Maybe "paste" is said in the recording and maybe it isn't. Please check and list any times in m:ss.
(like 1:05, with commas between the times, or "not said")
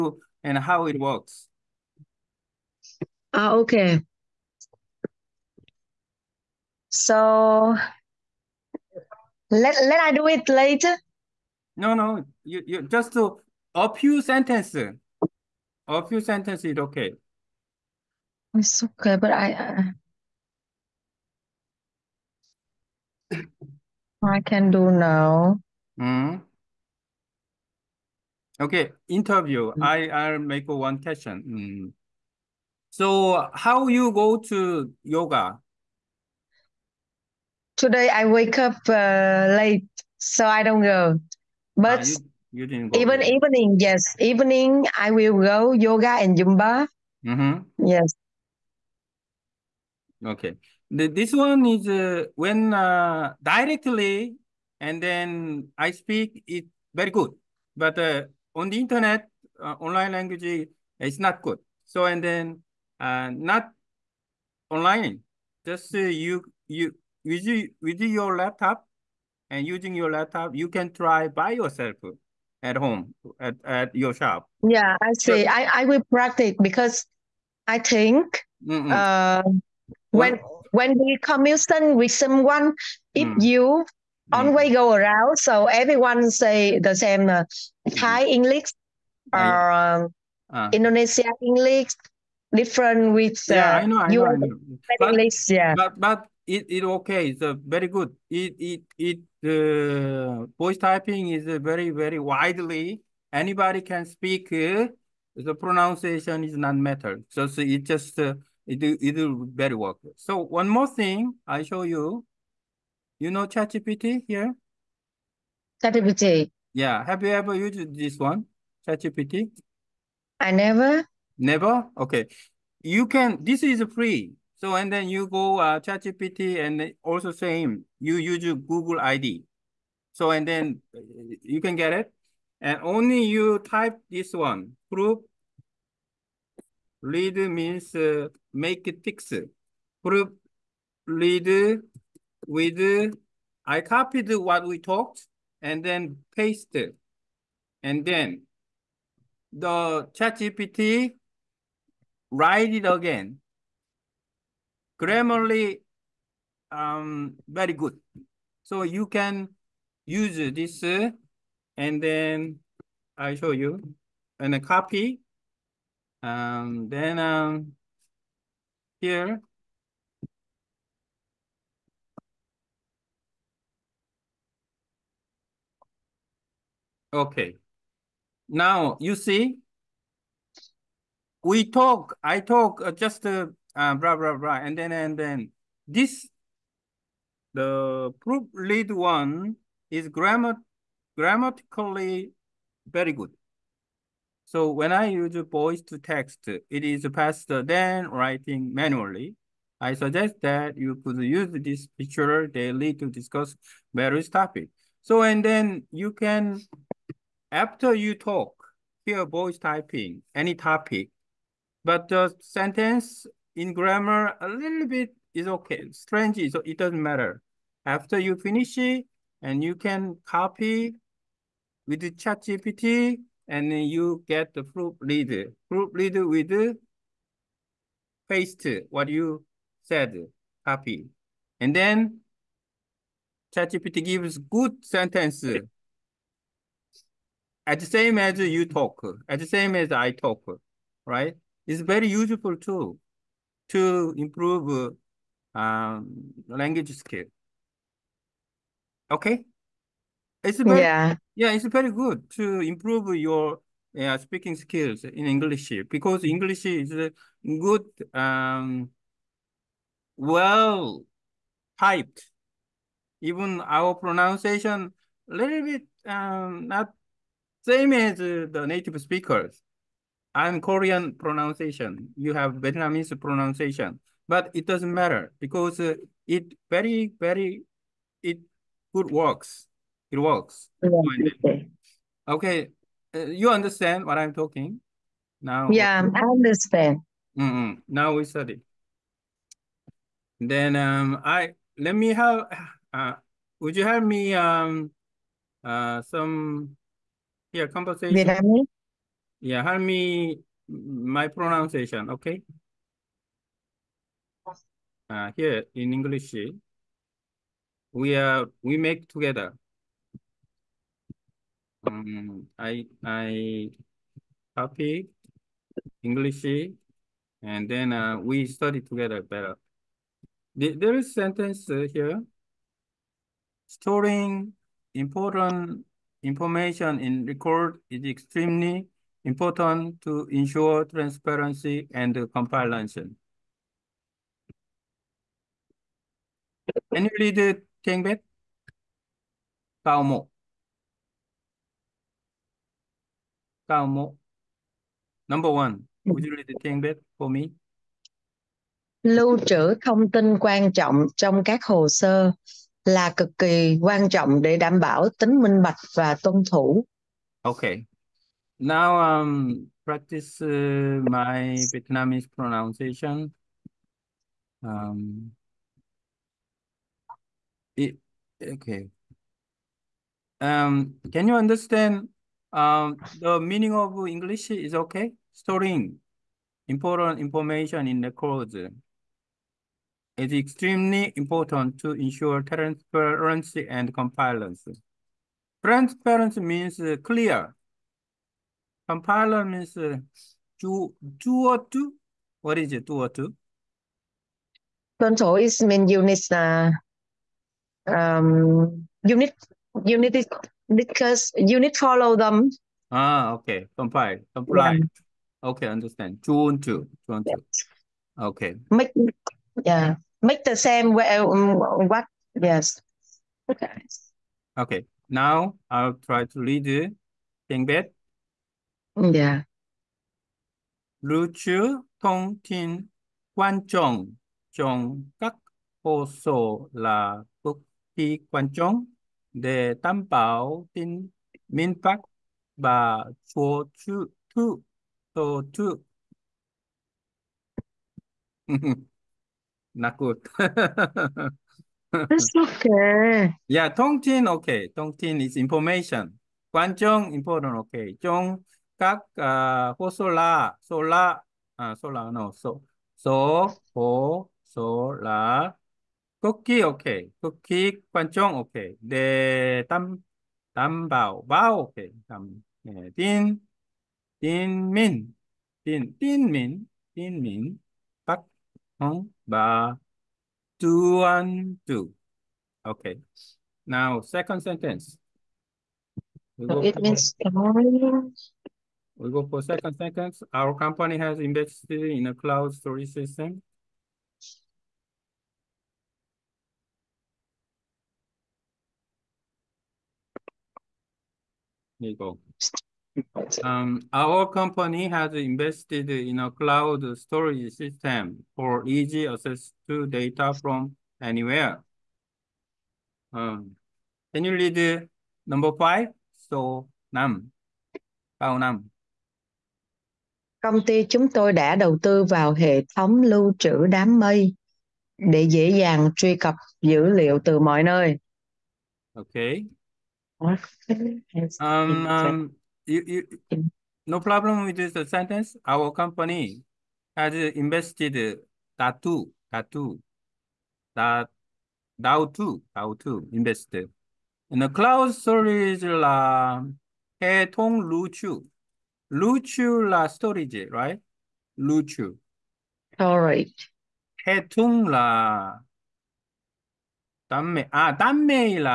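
2:26, 3:48.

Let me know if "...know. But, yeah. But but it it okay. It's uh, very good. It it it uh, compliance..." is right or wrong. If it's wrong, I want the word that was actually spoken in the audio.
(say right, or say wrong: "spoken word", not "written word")
wrong: "voice", not "compliance".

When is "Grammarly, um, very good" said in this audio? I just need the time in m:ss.
2:35.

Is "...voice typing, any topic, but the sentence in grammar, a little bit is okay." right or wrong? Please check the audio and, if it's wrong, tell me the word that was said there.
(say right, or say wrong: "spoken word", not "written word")
right.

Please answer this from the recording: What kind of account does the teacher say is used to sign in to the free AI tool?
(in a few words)
Google ID.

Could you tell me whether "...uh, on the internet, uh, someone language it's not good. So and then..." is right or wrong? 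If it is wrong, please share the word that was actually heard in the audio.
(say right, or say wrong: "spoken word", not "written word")
wrong: "online", not "someone".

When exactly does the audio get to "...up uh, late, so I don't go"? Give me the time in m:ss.
0:38.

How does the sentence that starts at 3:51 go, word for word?
And then ChatGPT gives good sentence.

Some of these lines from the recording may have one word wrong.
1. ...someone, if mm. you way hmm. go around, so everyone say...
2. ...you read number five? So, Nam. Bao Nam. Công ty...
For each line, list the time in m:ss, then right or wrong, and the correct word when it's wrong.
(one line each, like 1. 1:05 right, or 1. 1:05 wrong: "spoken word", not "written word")
1. 1:22 right
2. 8:24 right.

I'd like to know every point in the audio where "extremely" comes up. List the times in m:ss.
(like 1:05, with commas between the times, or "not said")
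5:28, 6:20.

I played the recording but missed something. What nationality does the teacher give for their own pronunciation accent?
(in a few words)
Korean.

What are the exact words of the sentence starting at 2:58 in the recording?
Now you see, we talk, I talk uh, just uh, uh, blah, blah, blah.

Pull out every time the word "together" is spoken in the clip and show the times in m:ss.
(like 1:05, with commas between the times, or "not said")
5:09, 5:18.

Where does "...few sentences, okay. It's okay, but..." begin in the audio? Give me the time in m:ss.
0:16.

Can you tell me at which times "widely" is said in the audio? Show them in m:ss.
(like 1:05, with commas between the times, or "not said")
1:42.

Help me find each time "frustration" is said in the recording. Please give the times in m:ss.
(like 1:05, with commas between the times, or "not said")
not said.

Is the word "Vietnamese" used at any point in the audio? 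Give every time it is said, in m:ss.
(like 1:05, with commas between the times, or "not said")
4:32, 4:58, 6:01.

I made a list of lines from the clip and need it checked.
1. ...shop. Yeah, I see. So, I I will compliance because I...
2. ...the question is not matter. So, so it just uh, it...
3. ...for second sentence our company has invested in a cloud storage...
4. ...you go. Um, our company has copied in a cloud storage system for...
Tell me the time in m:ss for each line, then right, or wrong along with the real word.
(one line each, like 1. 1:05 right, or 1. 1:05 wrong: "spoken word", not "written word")
1. 1:14 wrong: "practice", not "compliance"
2. 1:45 wrong: "pronunciation", not "question"
3. 7:59 right
4. 8:11 wrong: "invested", not "copied".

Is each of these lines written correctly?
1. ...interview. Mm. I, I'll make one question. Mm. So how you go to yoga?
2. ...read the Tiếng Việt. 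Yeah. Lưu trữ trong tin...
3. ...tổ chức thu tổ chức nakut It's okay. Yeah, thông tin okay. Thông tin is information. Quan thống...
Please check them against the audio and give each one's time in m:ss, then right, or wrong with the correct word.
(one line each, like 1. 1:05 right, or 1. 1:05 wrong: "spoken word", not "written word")
1. 0:29 right
2. 6:56 wrong: "thông", not "trong"
3. 7:13 wrong: "trọng", not "thống".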